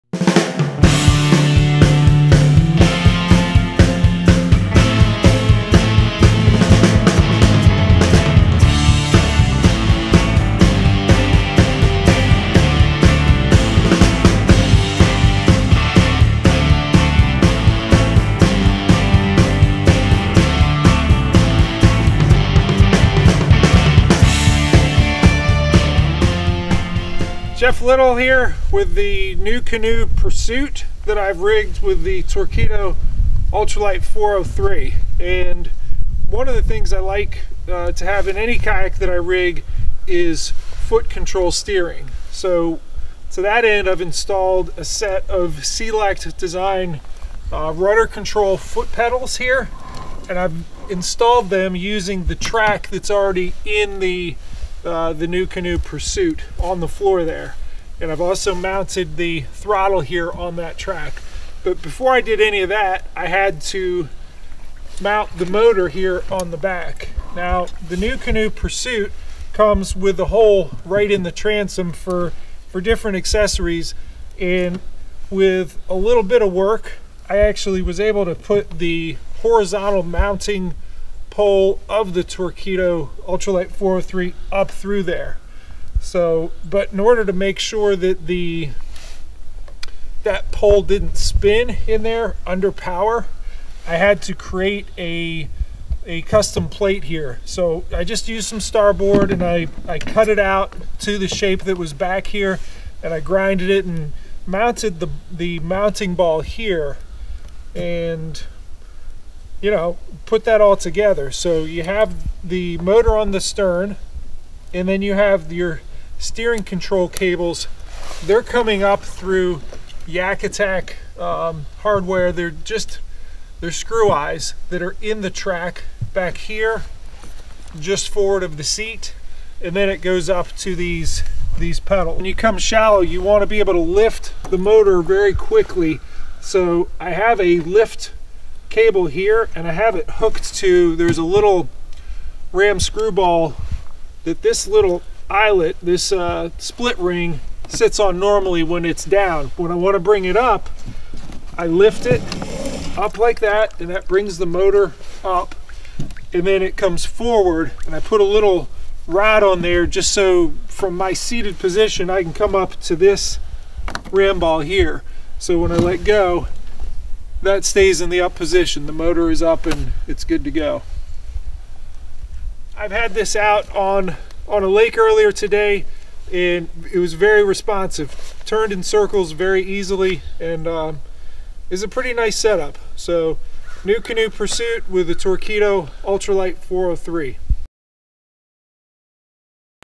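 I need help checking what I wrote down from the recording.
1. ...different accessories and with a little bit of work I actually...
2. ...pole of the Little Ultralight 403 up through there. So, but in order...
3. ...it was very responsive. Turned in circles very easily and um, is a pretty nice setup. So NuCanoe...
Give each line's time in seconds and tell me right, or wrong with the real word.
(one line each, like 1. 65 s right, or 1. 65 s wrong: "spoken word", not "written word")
1. 72 s right
2. 81 s wrong: "Torqeedo", not "Little"
3. 176 s right.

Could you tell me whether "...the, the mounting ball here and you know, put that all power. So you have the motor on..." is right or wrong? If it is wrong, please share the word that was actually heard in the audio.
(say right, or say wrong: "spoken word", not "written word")
wrong: "together", not "power".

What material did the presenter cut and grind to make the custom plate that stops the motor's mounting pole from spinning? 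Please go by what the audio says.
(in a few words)
starboard.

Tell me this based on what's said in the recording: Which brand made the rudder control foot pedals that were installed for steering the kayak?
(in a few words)
Select design.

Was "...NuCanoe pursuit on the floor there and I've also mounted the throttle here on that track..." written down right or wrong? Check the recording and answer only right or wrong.
right.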